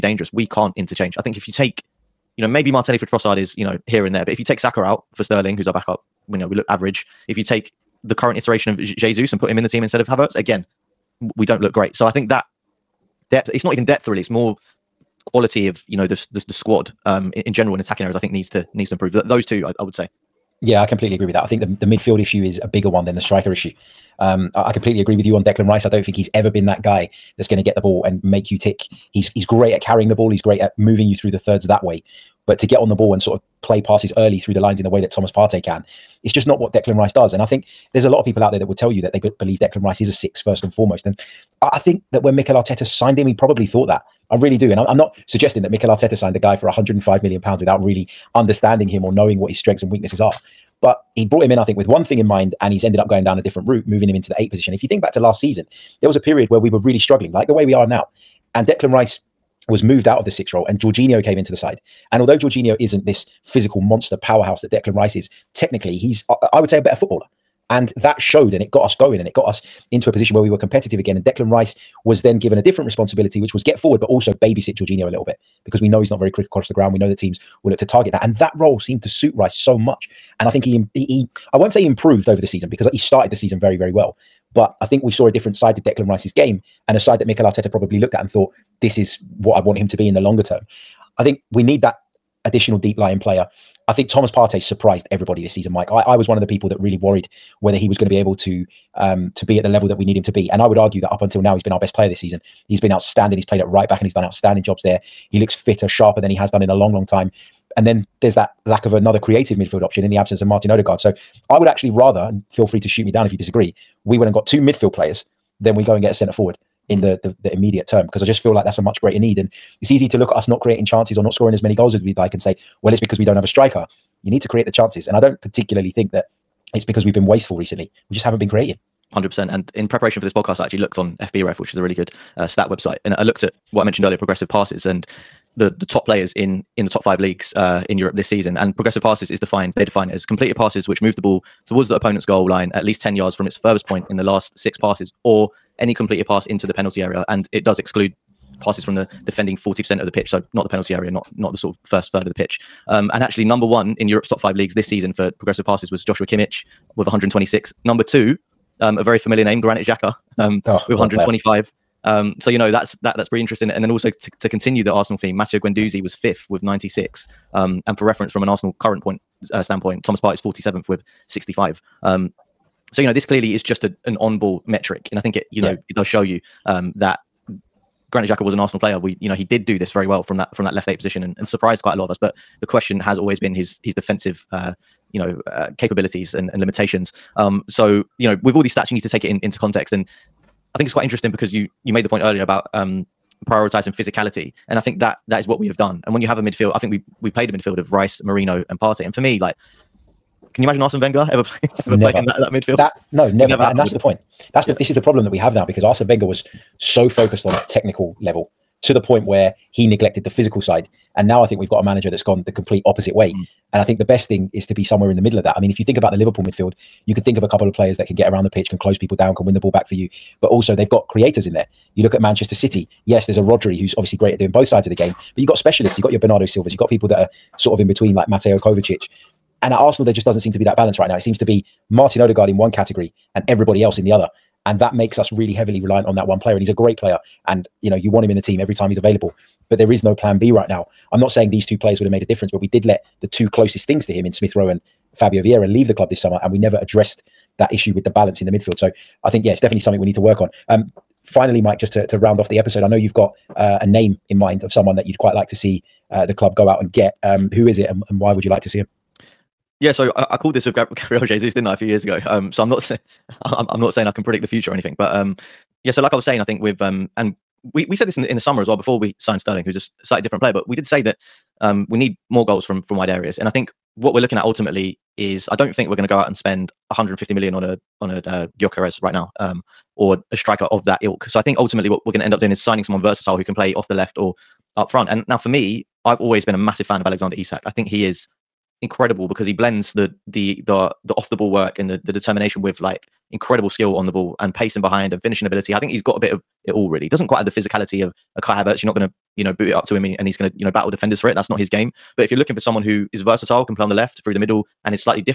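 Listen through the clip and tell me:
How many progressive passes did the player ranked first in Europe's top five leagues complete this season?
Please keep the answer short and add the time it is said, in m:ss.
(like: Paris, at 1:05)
126, at 2:37.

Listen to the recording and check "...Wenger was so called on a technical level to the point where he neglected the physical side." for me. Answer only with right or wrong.
wrong.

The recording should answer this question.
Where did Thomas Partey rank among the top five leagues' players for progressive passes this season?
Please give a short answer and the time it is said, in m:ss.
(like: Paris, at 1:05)
47th, at 2:50.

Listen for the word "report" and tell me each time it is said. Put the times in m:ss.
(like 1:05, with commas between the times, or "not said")
not said.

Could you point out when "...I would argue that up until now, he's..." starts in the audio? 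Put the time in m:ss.
1:40.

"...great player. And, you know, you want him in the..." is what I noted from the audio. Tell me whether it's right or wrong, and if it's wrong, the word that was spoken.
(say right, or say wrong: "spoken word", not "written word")
right.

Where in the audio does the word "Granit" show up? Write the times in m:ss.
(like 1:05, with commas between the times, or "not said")
2:39, 2:58.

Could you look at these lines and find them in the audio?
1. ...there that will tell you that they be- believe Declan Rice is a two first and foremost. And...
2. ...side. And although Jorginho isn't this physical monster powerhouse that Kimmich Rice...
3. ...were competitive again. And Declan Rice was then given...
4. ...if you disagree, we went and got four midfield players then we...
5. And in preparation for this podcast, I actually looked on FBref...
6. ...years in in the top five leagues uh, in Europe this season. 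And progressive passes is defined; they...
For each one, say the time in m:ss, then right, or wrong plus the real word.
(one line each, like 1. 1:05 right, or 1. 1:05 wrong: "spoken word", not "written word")
1. 0:38 wrong: "six", not "two"
2. 1:01 wrong: "Declan", not "Kimmich"
3. 1:10 right
4. 1:53 wrong: "two", not "four"
5. 2:09 right
6. 2:16 wrong: "players", not "years".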